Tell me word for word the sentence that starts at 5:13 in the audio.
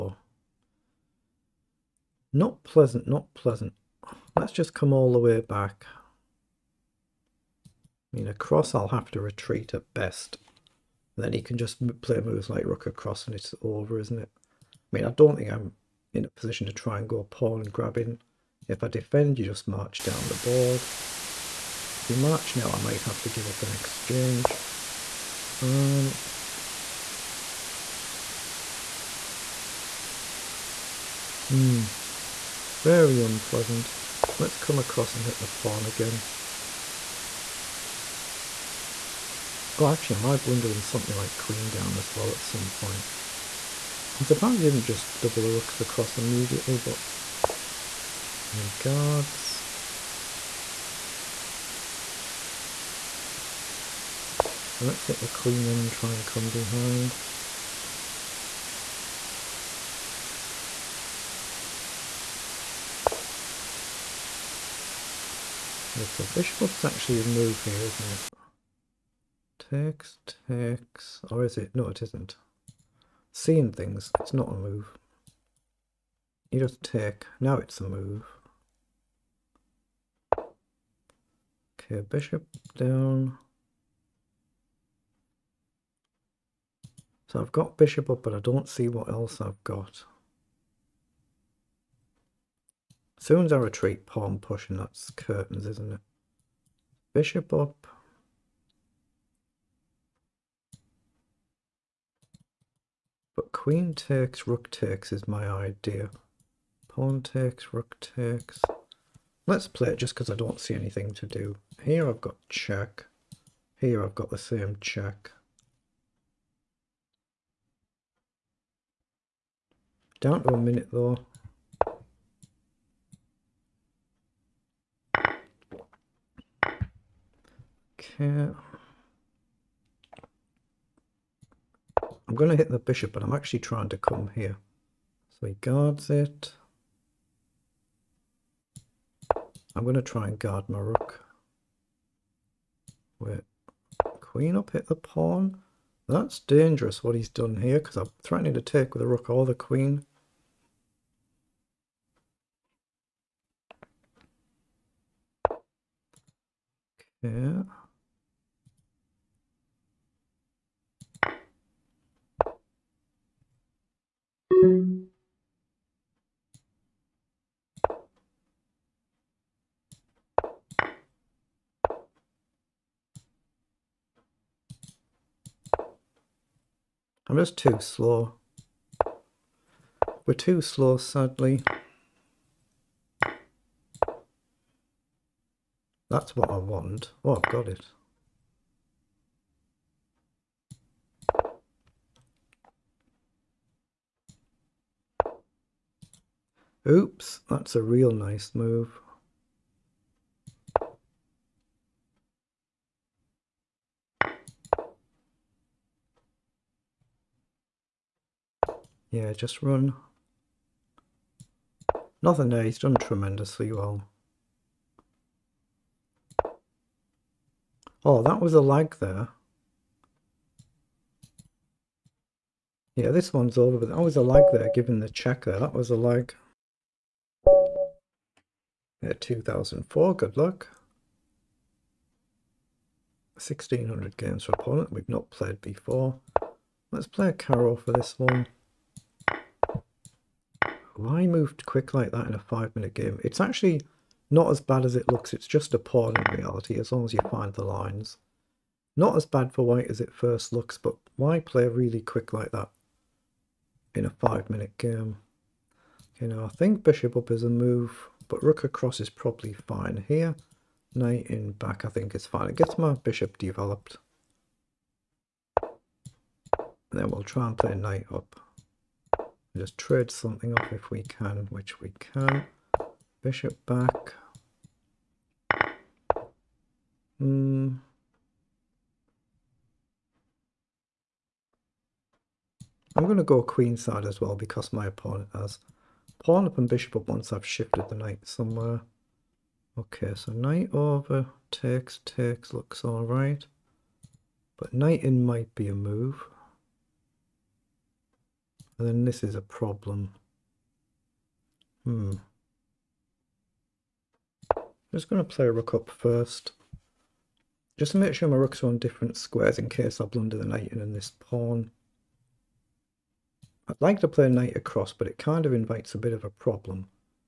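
I'd like to play a knight across, but it kind of invites a bit of a problem.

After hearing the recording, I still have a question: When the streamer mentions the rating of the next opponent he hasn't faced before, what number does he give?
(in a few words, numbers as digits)
2004.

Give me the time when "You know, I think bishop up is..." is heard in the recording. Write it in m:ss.
4:16.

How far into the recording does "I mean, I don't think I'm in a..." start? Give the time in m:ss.
0:14.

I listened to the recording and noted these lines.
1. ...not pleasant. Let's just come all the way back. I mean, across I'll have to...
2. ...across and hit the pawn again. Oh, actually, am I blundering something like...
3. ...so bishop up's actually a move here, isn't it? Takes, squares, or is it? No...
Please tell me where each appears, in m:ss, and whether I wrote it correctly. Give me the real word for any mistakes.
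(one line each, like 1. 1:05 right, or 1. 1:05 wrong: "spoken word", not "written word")
1. 0:03 right
2. 0:34 right
3. 1:06 wrong: "takes", not "squares".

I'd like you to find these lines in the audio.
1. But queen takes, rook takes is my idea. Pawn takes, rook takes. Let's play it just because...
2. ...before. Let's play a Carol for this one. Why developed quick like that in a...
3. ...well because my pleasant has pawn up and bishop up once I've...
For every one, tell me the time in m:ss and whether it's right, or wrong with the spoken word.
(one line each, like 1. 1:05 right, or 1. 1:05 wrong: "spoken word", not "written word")
1. 1:43 right
2. 3:55 wrong: "moved", not "developed"
3. 4:44 wrong: "opponent", not "pleasant".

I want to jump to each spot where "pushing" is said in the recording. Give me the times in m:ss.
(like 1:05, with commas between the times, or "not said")
1:34.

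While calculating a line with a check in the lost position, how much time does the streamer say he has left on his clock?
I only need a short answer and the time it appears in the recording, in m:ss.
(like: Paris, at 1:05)
a minute, at 2:00.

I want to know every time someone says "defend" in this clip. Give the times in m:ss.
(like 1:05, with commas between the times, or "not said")
0:18.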